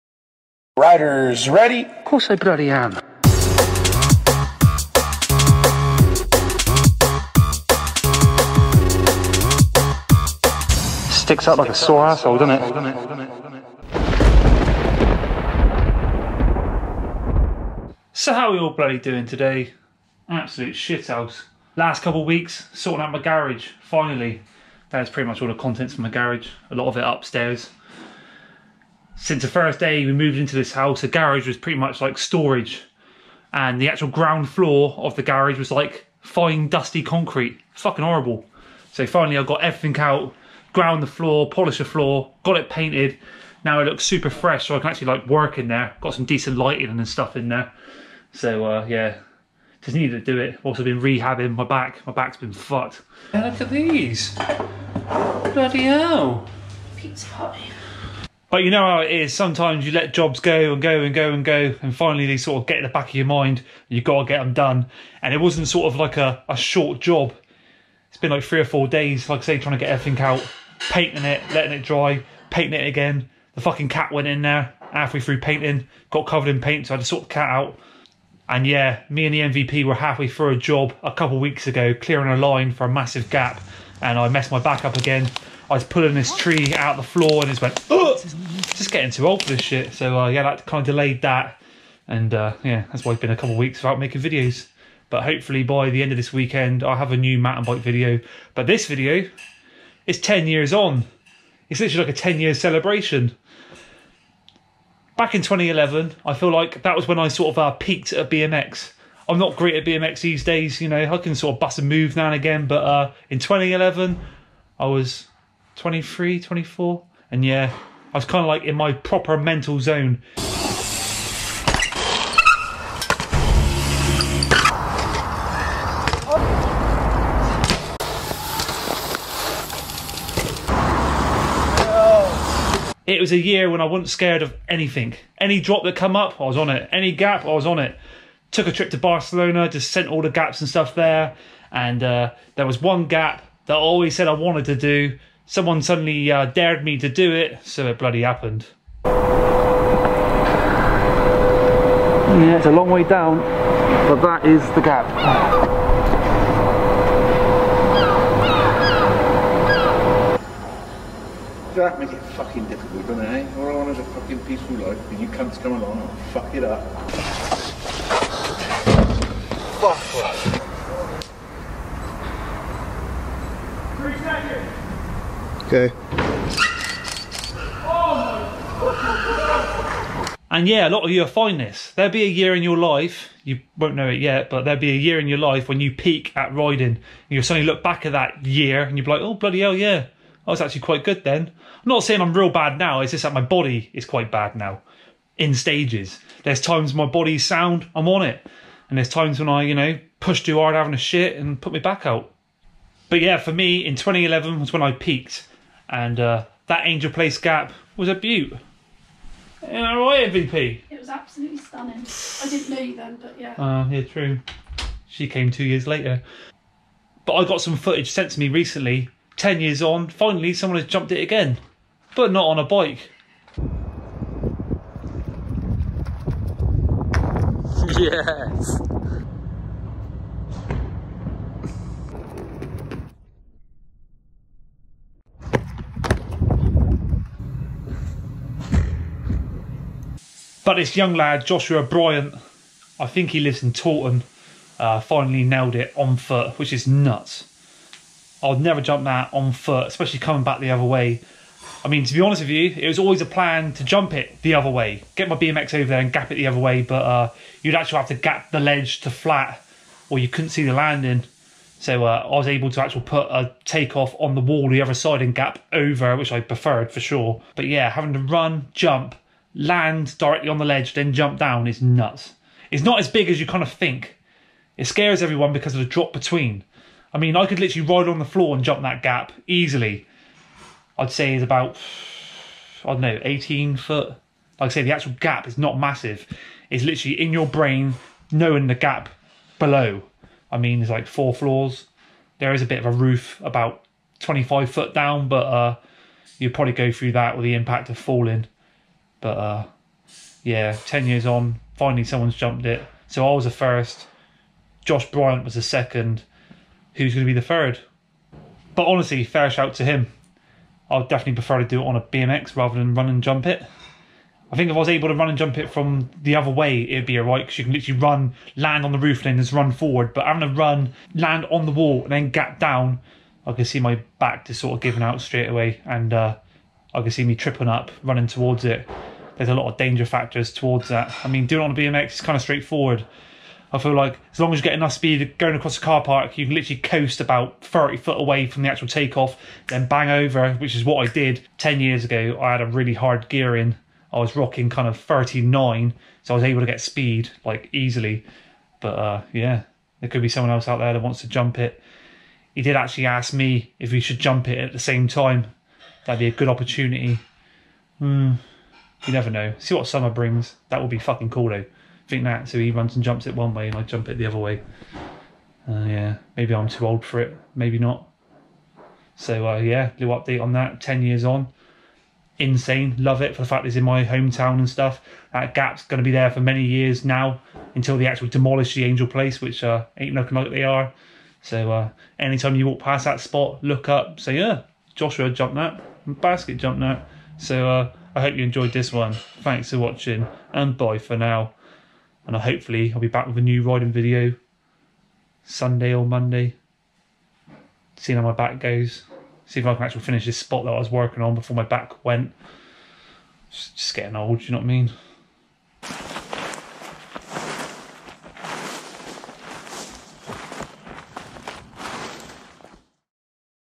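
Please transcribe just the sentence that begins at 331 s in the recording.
I mean, doing it on a BMX is kind of straightforward.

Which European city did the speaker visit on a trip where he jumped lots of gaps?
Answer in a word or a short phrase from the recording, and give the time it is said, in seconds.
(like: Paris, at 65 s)
Barcelona, at 138 s.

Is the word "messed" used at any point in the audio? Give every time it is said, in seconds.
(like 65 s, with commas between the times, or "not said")
84 s.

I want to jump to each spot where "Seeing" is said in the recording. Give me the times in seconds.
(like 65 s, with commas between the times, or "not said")
397 s.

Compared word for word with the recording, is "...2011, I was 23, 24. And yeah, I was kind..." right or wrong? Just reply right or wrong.
right.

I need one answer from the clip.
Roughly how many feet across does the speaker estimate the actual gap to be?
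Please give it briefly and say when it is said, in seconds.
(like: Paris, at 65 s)
18 feet, at 283 s.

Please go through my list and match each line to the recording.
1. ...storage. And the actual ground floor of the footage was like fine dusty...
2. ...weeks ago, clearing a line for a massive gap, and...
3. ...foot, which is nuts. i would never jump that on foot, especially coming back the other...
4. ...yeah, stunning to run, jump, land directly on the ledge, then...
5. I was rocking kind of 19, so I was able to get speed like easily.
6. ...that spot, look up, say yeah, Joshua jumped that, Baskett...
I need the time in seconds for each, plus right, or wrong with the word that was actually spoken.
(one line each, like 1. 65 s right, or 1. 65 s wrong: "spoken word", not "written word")
1. 32 s wrong: "garage", not "footage"
2. 81 s right
3. 246 s right
4. 267 s wrong: "having", not "stunning"
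5. 344 s wrong: "39", not "19"
6. 383 s right.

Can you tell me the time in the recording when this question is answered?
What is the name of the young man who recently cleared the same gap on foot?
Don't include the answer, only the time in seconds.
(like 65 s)
241 s.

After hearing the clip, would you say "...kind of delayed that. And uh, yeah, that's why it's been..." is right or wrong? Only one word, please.
right.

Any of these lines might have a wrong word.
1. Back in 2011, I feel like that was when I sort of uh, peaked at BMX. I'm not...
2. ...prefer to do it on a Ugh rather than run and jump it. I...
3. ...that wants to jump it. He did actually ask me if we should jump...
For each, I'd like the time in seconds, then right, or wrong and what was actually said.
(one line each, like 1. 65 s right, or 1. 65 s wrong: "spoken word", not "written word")
1. 105 s right
2. 311 s wrong: "BMX", not "Ugh"
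3. 350 s right.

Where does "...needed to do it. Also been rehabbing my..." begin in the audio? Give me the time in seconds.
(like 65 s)
49 s.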